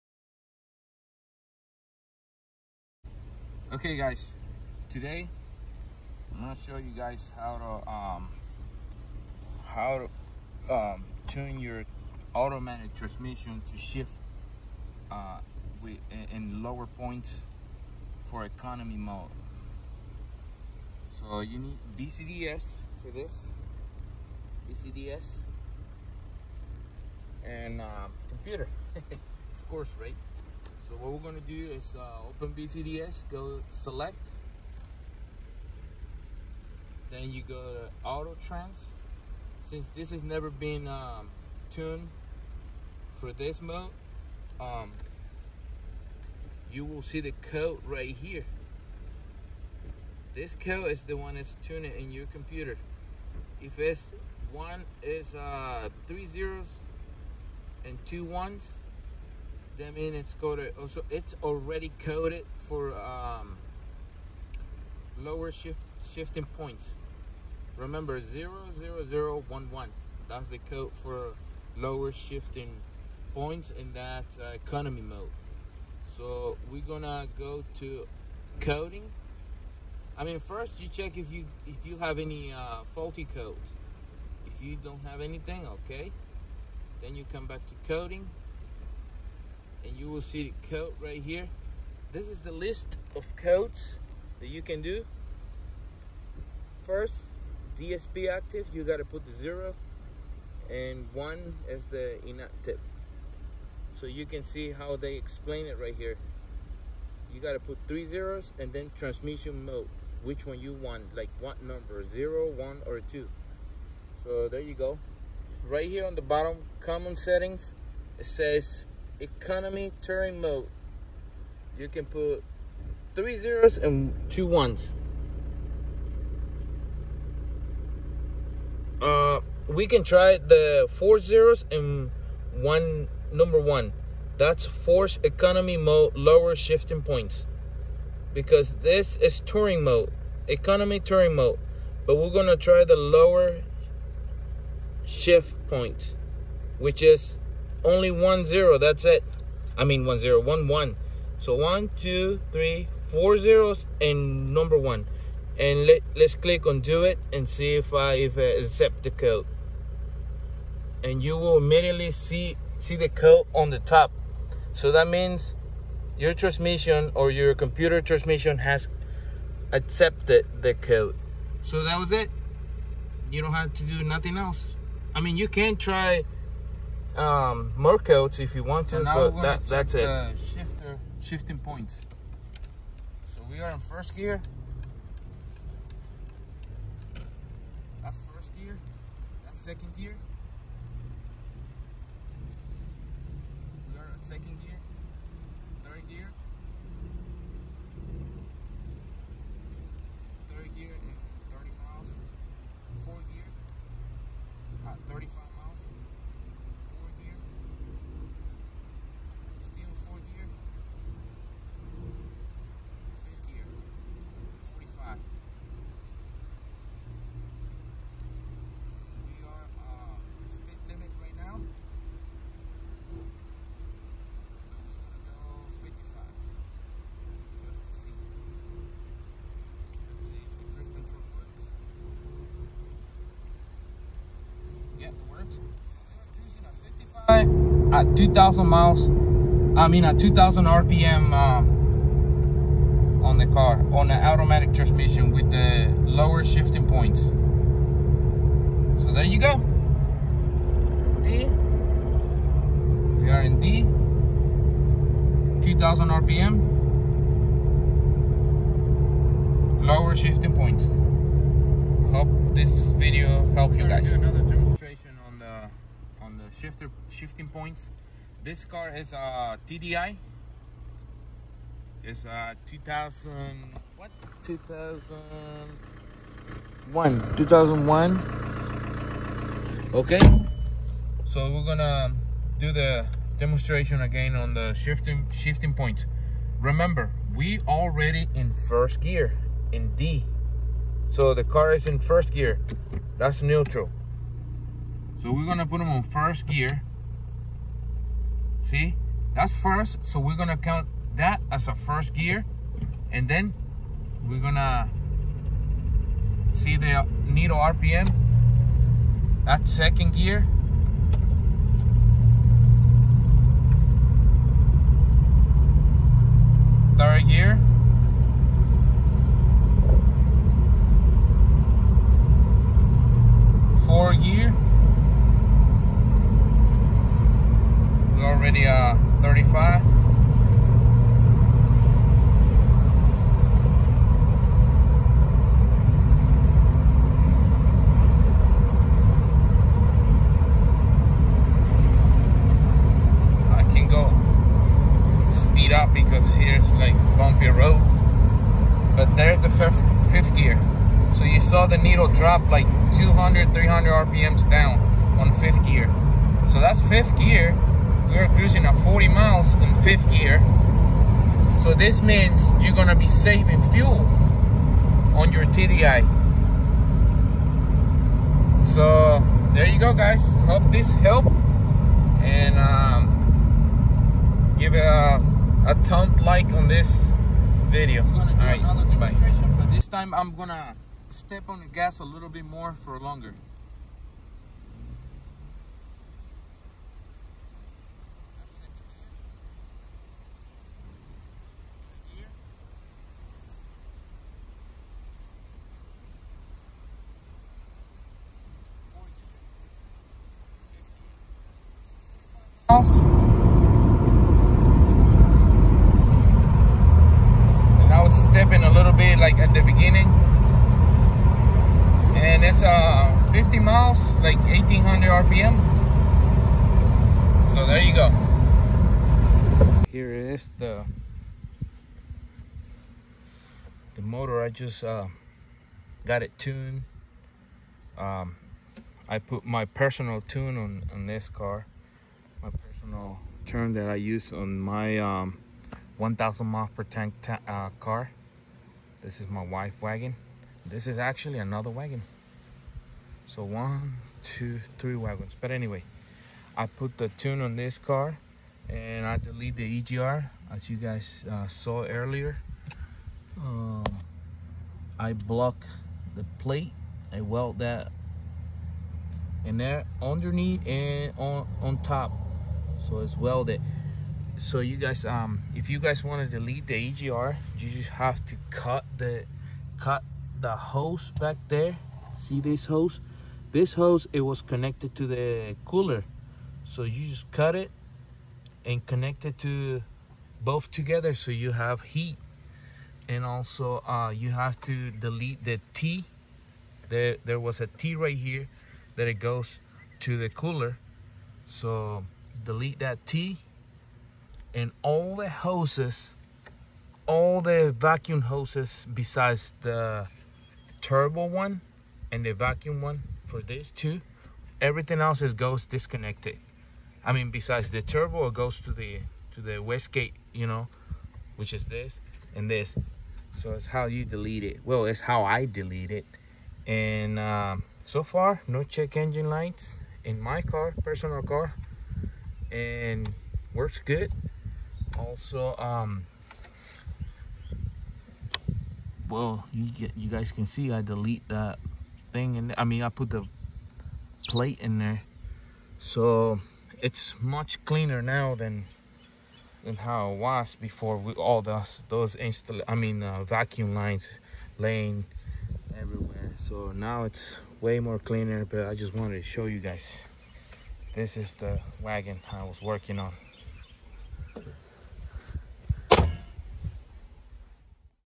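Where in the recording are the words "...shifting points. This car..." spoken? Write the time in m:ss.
4:27.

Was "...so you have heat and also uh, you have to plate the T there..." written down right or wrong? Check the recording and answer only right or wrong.
wrong.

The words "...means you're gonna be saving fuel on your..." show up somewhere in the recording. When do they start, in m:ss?
6:02.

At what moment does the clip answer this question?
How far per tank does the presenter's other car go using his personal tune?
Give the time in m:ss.
7:15.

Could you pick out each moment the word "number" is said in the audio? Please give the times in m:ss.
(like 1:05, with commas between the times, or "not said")
1:51, 2:13, 2:34.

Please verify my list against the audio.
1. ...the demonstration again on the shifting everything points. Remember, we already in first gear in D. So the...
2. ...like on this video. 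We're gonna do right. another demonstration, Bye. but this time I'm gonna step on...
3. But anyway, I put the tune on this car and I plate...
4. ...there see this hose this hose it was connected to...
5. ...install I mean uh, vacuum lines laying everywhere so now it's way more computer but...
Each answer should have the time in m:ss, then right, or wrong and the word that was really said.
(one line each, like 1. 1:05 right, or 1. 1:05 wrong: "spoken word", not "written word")
1. 4:42 wrong: "shifting", not "everything"
2. 6:16 right
3. 7:25 wrong: "delete", not "plate"
4. 7:51 right
5. 9:02 wrong: "cleaner", not "computer".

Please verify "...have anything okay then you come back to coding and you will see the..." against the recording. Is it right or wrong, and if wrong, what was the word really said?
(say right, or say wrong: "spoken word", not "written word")
right.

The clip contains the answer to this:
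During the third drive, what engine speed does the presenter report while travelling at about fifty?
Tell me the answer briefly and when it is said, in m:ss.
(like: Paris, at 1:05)
1800 RPM, at 6:54.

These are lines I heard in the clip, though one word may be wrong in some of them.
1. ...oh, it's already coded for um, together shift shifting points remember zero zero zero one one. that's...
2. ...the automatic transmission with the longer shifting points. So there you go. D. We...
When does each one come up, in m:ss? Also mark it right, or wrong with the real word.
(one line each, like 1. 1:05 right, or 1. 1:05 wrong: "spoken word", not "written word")
1. 1:01 wrong: "lower", not "together"
2. 4:04 wrong: "lower", not "longer".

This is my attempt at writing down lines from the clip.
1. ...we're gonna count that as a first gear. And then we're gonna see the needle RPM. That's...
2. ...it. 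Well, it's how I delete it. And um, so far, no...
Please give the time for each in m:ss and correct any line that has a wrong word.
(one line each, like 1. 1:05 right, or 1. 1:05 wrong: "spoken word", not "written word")
1. 5:00 right
2. 8:34 right.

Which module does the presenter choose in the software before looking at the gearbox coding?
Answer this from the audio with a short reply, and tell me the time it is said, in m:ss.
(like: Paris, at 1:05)
auto trans, at 0:38.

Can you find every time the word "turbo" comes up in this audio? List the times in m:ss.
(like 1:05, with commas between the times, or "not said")
8:20, 8:27.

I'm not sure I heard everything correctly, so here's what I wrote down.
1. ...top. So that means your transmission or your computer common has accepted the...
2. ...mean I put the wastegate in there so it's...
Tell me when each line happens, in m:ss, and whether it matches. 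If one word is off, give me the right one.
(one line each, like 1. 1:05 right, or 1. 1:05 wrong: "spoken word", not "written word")
1. 2:43 wrong: "transmission", not "common"
2. 8:52 wrong: "plate", not "wastegate".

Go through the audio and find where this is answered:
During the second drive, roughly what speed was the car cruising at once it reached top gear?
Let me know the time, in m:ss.
5:58.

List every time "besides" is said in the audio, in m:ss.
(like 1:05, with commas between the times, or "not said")
8:18, 8:27.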